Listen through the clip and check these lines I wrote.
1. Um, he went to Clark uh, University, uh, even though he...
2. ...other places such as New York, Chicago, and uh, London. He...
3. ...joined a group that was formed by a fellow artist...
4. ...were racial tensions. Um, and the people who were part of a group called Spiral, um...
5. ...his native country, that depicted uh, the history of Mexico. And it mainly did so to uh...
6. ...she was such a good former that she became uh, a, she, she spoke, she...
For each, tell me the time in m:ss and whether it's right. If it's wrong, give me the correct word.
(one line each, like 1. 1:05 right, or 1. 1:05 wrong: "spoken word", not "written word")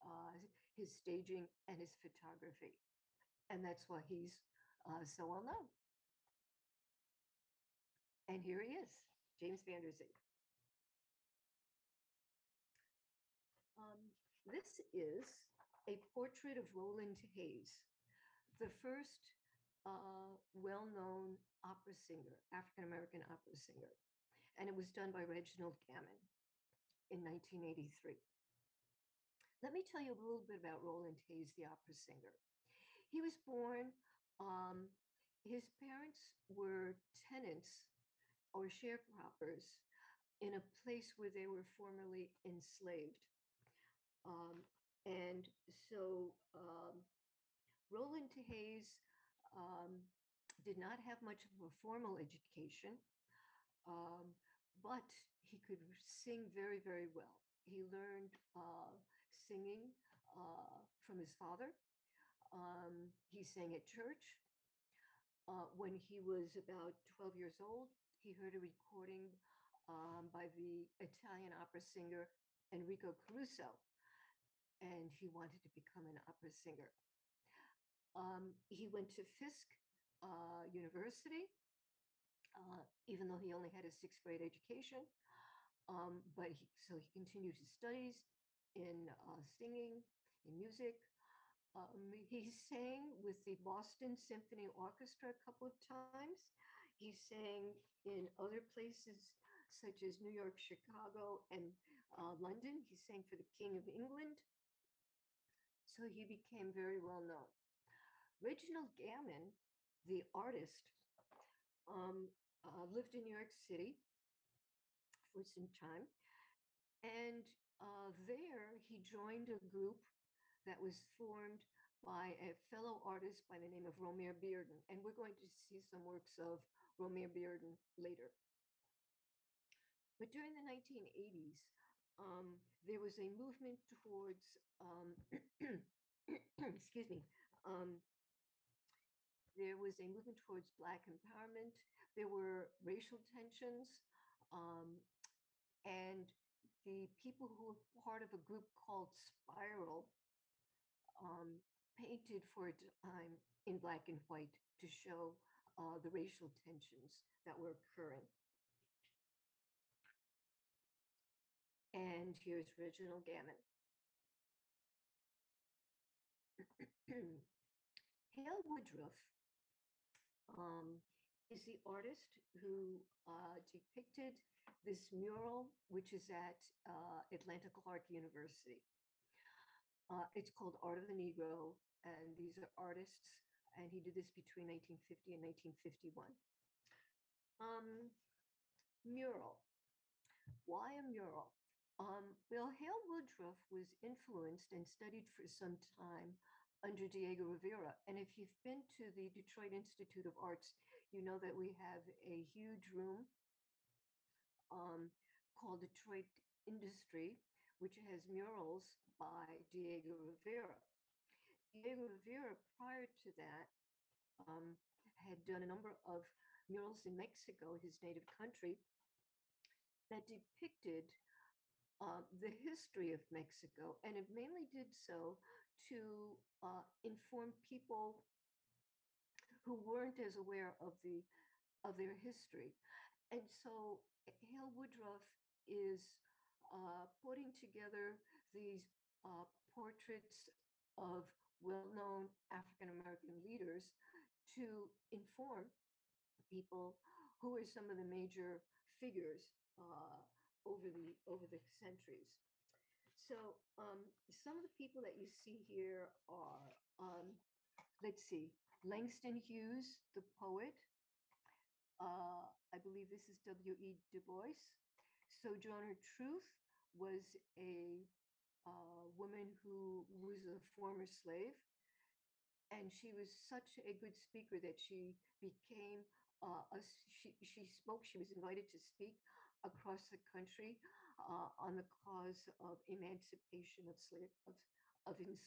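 1. 1:18 wrong: "Fisk", not "Clark"
2. 1:38 right
3. 1:59 right
4. 2:22 right
5. 3:37 right
6. 4:32 wrong: "speaker", not "former".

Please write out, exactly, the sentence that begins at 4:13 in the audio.
So um, some of the people that you see here are, um, let's see, Langston Hughes, the poet.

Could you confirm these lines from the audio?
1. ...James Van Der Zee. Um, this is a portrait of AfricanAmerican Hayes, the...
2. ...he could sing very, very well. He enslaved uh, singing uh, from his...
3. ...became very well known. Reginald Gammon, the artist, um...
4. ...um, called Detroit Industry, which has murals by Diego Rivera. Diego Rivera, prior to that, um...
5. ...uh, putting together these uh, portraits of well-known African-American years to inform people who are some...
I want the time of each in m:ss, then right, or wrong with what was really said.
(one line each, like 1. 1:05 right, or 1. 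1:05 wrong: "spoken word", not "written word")
1. 0:09 wrong: "Roland", not "AfricanAmerican"
2. 0:55 wrong: "learned", not "enslaved"
3. 1:46 right
4. 3:24 right
5. 3:56 wrong: "leaders", not "years".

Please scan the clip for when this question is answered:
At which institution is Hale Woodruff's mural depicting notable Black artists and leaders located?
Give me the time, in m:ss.
2:57.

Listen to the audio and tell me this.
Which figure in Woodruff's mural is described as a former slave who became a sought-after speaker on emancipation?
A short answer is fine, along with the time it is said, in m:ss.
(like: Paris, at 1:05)
Sojourner Truth, at 4:25.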